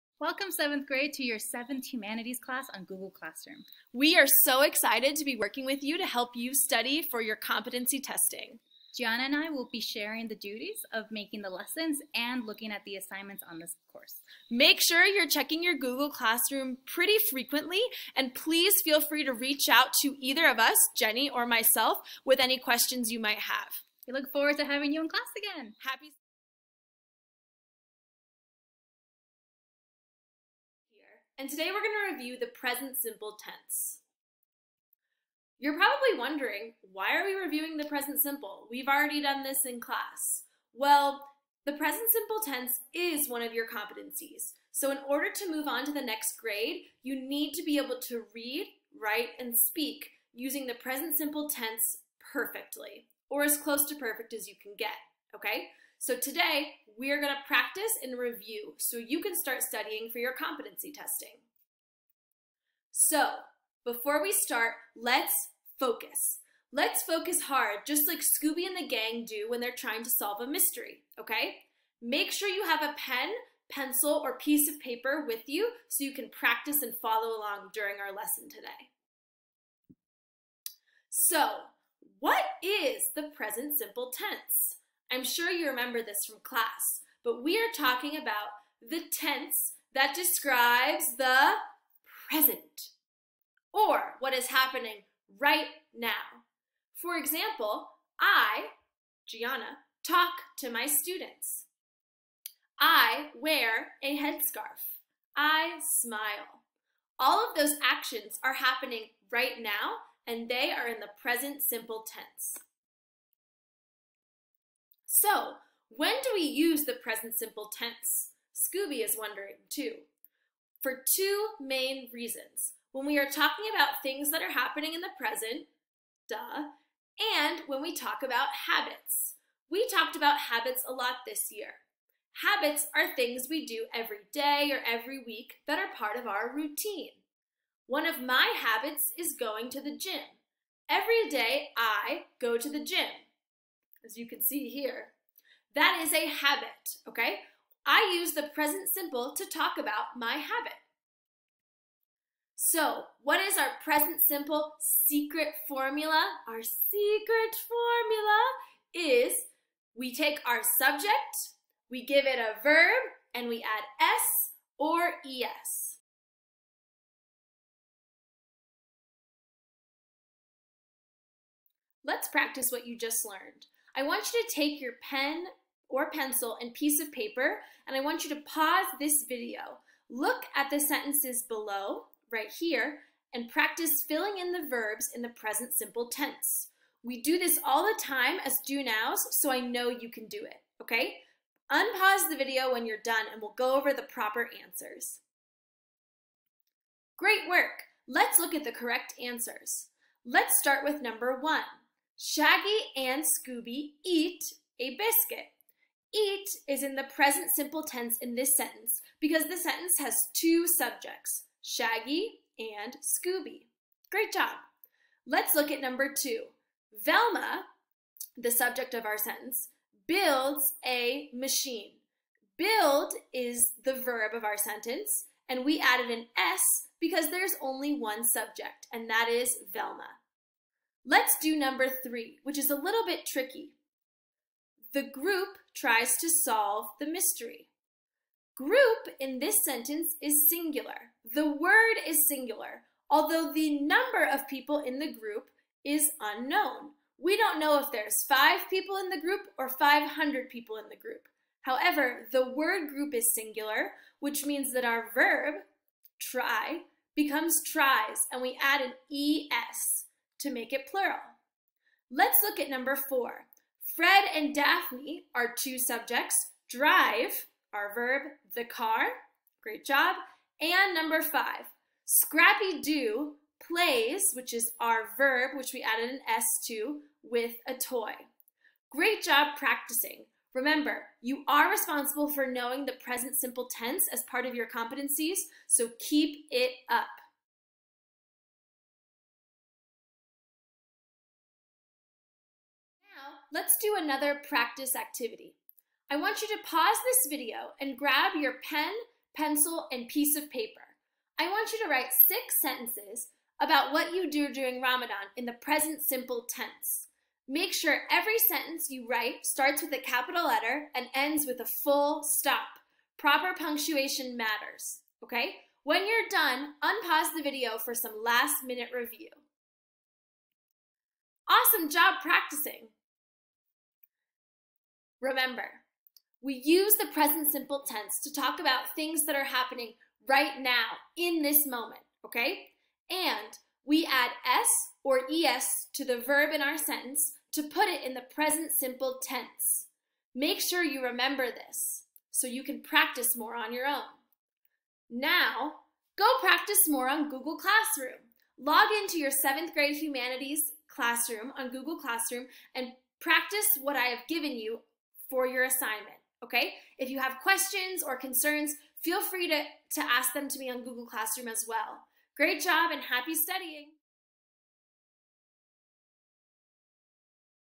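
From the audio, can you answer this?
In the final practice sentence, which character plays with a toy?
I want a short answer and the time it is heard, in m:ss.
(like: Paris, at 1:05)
Scrappy Doo, at 4:32.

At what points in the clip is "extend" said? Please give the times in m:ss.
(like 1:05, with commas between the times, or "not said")
not said.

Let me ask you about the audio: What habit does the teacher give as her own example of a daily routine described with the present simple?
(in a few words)
going to the gym.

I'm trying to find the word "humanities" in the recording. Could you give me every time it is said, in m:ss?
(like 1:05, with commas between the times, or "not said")
0:01, 5:49.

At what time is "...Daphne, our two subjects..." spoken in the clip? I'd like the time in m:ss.
4:24.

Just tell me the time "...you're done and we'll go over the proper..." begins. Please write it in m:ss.
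3:12.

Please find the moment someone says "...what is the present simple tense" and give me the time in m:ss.
1:22.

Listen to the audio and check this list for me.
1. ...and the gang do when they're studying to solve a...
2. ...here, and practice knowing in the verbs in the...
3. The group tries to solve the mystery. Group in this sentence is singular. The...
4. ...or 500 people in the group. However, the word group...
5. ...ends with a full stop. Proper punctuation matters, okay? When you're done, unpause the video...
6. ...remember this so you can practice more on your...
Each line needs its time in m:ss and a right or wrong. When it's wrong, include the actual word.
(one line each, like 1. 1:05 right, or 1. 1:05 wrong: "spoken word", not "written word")
1. 1:08 wrong: "trying", not "studying"
2. 3:02 wrong: "filling", not "knowing"
3. 3:54 right
4. 4:09 right
5. 5:11 right
6. 5:41 right.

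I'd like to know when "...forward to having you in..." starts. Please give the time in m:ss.
0:24.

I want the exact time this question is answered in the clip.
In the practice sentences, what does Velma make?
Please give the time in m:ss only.
3:40.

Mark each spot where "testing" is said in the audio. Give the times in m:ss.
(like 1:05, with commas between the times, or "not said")
0:07, 1:00.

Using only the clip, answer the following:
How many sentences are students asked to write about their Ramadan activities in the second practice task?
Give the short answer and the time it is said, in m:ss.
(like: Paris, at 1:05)
6, at 5:02.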